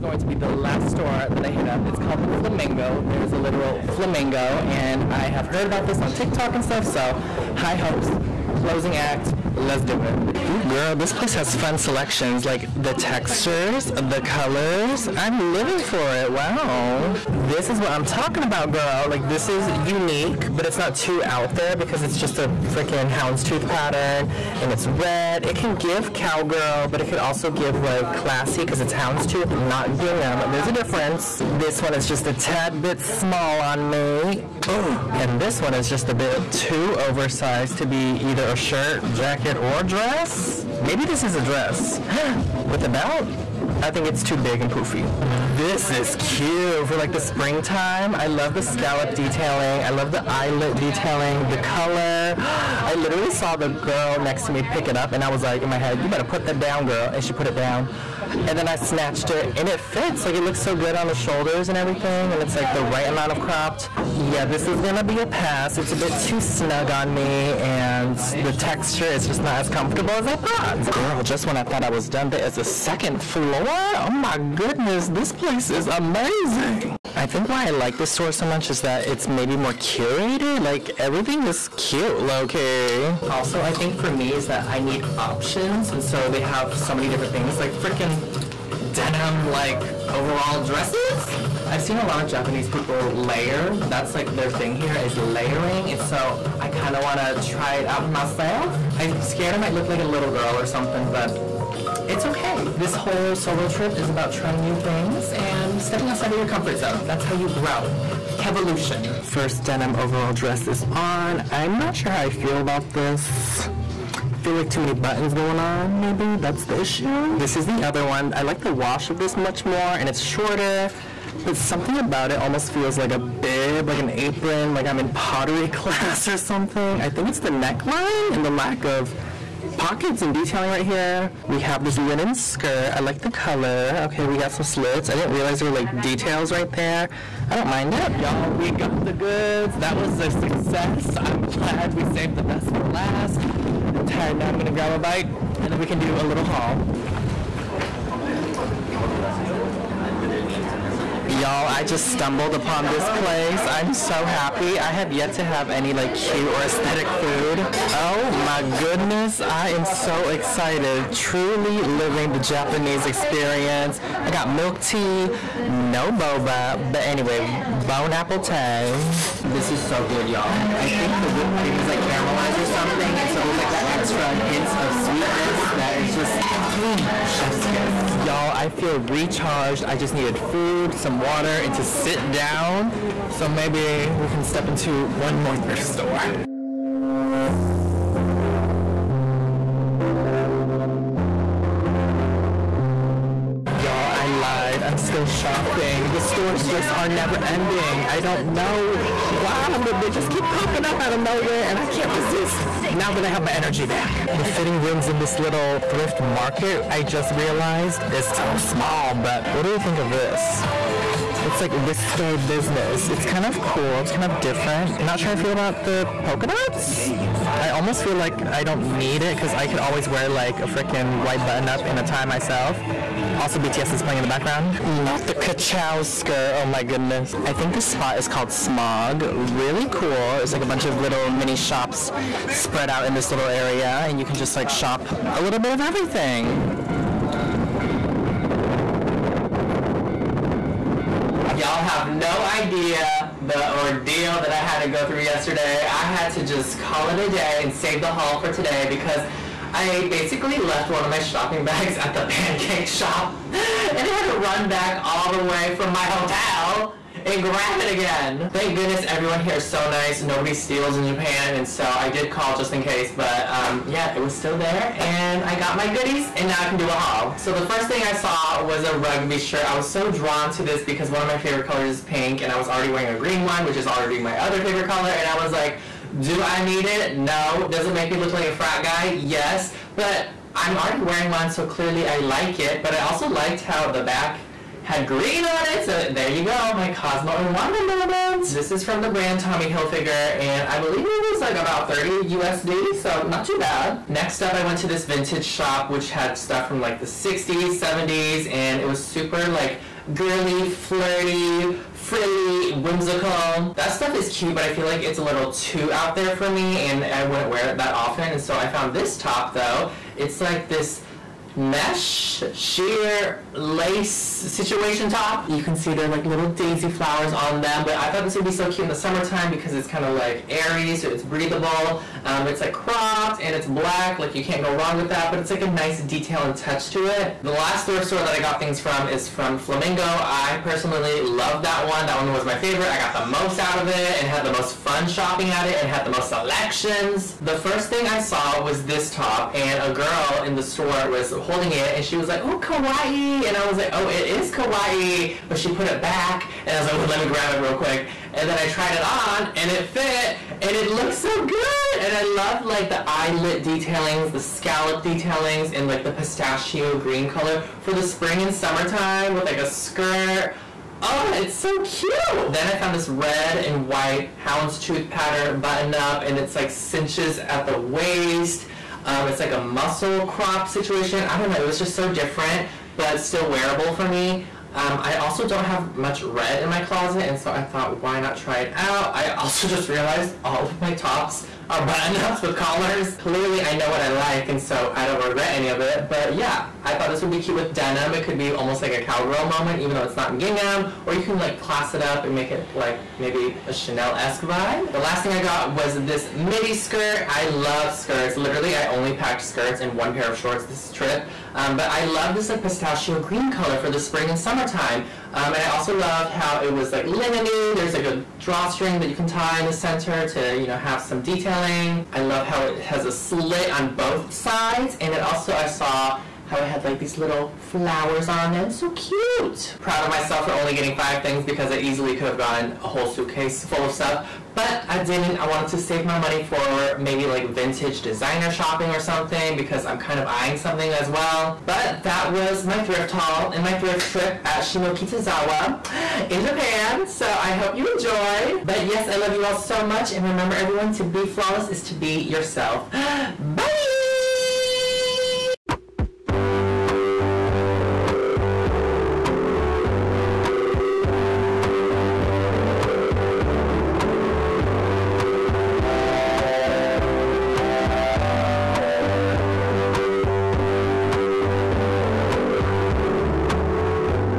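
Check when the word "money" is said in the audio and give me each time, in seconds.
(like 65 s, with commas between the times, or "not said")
426 s.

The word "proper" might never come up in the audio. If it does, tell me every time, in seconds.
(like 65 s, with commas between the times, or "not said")
not said.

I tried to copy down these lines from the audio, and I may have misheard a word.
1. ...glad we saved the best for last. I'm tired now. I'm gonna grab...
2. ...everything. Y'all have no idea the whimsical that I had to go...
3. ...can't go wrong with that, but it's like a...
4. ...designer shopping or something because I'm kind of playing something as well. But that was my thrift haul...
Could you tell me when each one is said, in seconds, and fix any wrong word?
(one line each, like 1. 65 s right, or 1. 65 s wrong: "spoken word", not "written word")
1. 141 s right
2. 235 s wrong: "ordeal", not "whimsical"
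3. 324 s right
4. 428 s wrong: "eyeing", not "playing".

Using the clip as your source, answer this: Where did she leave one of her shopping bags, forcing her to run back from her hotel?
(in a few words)
The pancake shop.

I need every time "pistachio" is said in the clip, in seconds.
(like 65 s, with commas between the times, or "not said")
356 s, 402 s.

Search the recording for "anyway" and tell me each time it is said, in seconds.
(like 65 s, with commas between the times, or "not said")
167 s.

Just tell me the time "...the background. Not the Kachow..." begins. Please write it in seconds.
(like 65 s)
224 s.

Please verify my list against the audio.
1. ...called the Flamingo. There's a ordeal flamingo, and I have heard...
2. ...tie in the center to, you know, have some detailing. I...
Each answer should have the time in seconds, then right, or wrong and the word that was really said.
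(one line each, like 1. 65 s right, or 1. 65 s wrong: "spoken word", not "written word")
1. 1 s wrong: "literal", not "ordeal"
2. 409 s right.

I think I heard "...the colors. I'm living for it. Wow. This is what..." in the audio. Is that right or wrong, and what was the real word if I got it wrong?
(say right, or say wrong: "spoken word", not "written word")
right.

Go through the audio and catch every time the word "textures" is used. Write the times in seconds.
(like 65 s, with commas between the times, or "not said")
12 s, 68 s.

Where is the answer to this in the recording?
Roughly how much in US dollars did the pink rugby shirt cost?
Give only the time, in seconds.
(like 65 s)
291 s.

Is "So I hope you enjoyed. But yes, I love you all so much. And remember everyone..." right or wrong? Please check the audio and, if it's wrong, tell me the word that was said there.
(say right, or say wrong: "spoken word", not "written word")
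right.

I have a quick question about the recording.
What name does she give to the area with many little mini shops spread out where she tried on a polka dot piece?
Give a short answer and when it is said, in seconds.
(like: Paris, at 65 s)
Smog, at 228 s.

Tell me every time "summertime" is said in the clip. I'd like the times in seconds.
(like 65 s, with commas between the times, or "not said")
318 s, 358 s, 404 s.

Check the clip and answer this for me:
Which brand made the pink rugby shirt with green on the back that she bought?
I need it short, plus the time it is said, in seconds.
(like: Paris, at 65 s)
Tommy Hilfiger, at 289 s.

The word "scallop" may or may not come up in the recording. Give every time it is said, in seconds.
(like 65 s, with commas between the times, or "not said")
48 s, 354 s.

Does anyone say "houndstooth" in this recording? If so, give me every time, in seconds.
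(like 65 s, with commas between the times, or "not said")
23 s, 28 s, 364 s.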